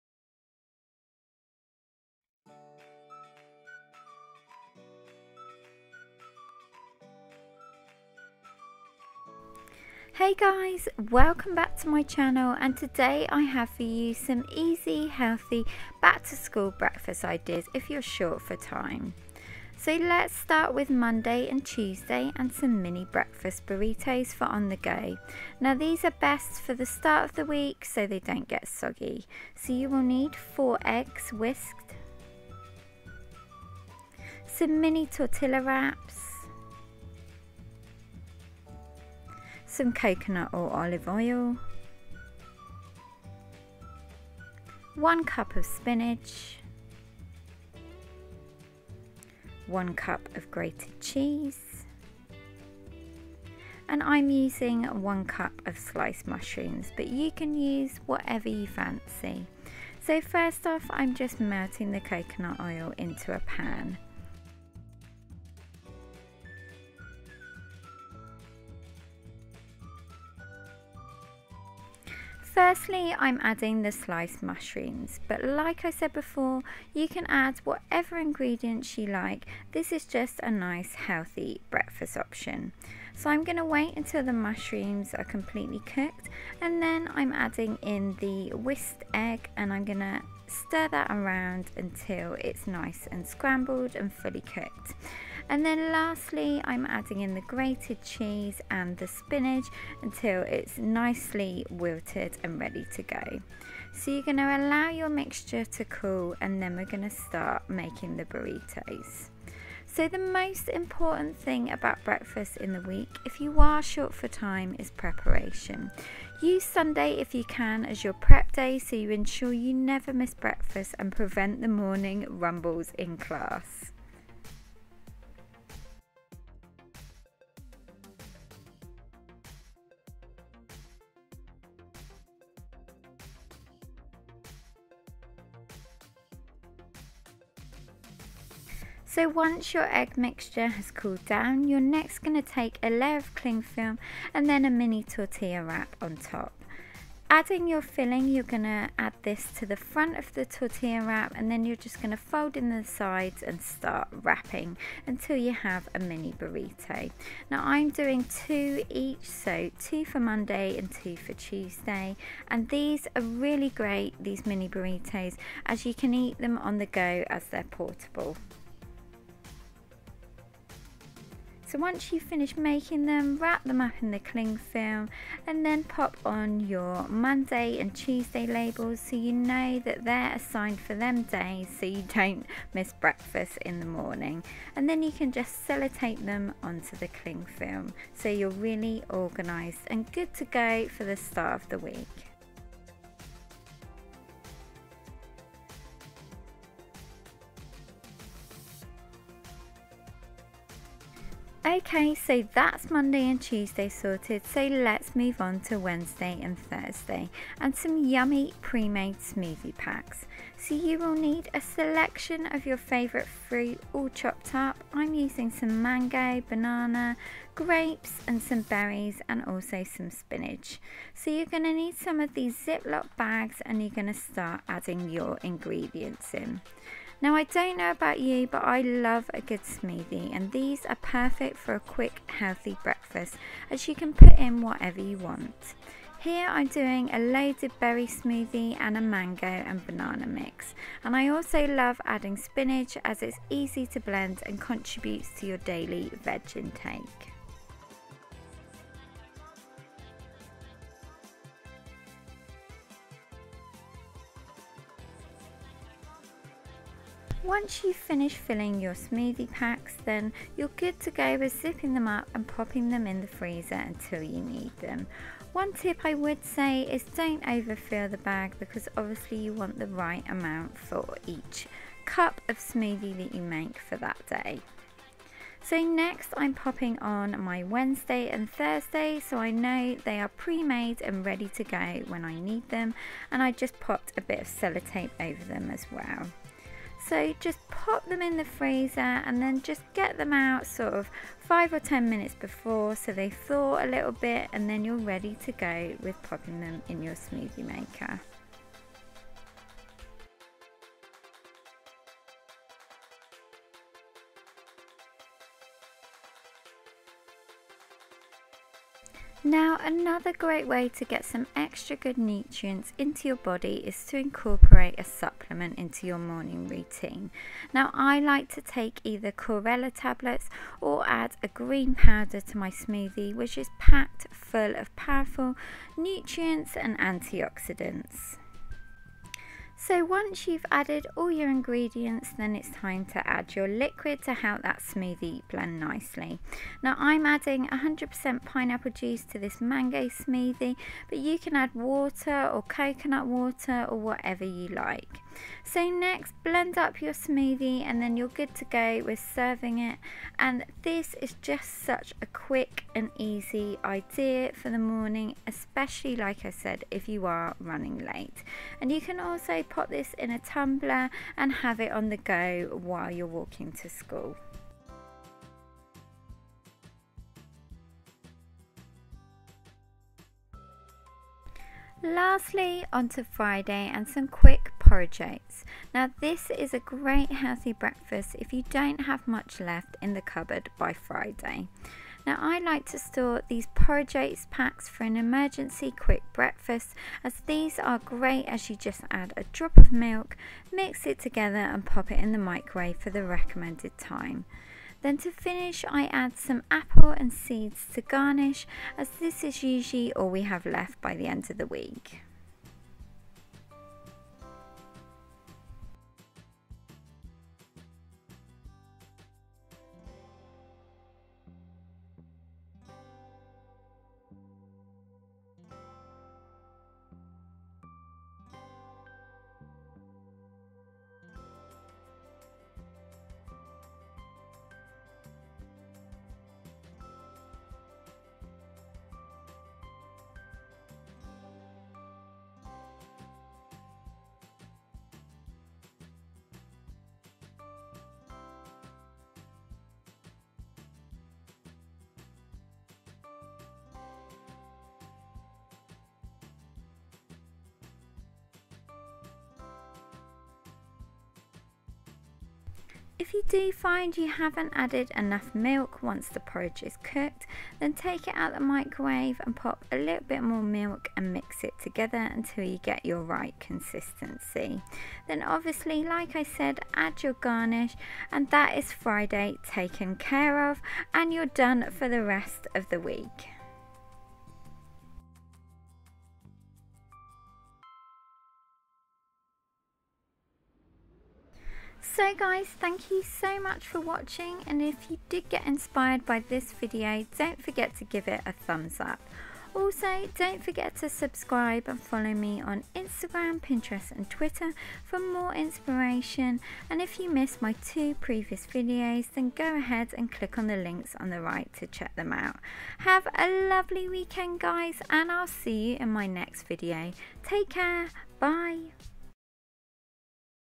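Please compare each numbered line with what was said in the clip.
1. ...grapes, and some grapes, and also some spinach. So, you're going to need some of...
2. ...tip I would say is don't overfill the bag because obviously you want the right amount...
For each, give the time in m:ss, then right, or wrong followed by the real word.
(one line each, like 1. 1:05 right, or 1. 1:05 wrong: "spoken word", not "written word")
1. 3:37 wrong: "berries", not "grapes"
2. 4:25 right.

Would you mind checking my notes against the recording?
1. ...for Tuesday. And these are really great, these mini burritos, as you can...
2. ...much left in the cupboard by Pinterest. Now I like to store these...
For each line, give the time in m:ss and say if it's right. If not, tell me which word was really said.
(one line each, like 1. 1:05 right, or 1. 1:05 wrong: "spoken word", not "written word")
1. 2:41 right
2. 6:19 wrong: "Friday", not "Pinterest".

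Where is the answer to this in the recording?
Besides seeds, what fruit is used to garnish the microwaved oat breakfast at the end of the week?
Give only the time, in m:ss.
6:36.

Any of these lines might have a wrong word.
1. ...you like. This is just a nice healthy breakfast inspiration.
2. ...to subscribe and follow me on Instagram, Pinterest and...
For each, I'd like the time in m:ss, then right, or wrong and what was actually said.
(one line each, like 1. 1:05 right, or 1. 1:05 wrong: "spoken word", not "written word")
1. 1:18 wrong: "option", not "inspiration"
2. 8:10 right.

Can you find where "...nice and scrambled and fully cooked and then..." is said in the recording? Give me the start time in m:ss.
1:32.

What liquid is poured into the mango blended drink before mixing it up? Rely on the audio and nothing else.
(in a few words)
pineapple juice.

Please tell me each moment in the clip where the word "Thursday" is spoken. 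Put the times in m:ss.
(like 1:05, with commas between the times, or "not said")
3:26, 4:38.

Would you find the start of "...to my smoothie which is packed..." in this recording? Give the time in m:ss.
5:22.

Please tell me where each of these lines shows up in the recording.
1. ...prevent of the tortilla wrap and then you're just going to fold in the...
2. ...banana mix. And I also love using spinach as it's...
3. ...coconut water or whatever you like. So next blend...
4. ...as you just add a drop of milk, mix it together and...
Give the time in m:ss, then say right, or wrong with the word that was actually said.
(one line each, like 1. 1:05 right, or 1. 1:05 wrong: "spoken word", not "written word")
1. 2:29 wrong: "front", not "prevent"
2. 3:59 wrong: "adding", not "using"
3. 5:42 right
4. 6:28 right.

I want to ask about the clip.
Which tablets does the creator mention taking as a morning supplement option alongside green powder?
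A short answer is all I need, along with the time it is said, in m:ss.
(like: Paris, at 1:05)
Chlorella, at 5:19.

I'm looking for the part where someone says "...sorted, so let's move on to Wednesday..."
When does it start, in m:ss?
3:23.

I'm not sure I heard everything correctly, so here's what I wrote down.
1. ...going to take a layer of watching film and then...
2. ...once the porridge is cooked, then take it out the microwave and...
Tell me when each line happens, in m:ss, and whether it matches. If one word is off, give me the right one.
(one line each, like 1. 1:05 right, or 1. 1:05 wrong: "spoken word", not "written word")
1. 2:22 wrong: "cling", not "watching"
2. 7:36 right.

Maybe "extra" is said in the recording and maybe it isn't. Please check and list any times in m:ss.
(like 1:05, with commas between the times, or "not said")
5:11.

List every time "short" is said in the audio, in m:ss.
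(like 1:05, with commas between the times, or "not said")
0:18, 1:53.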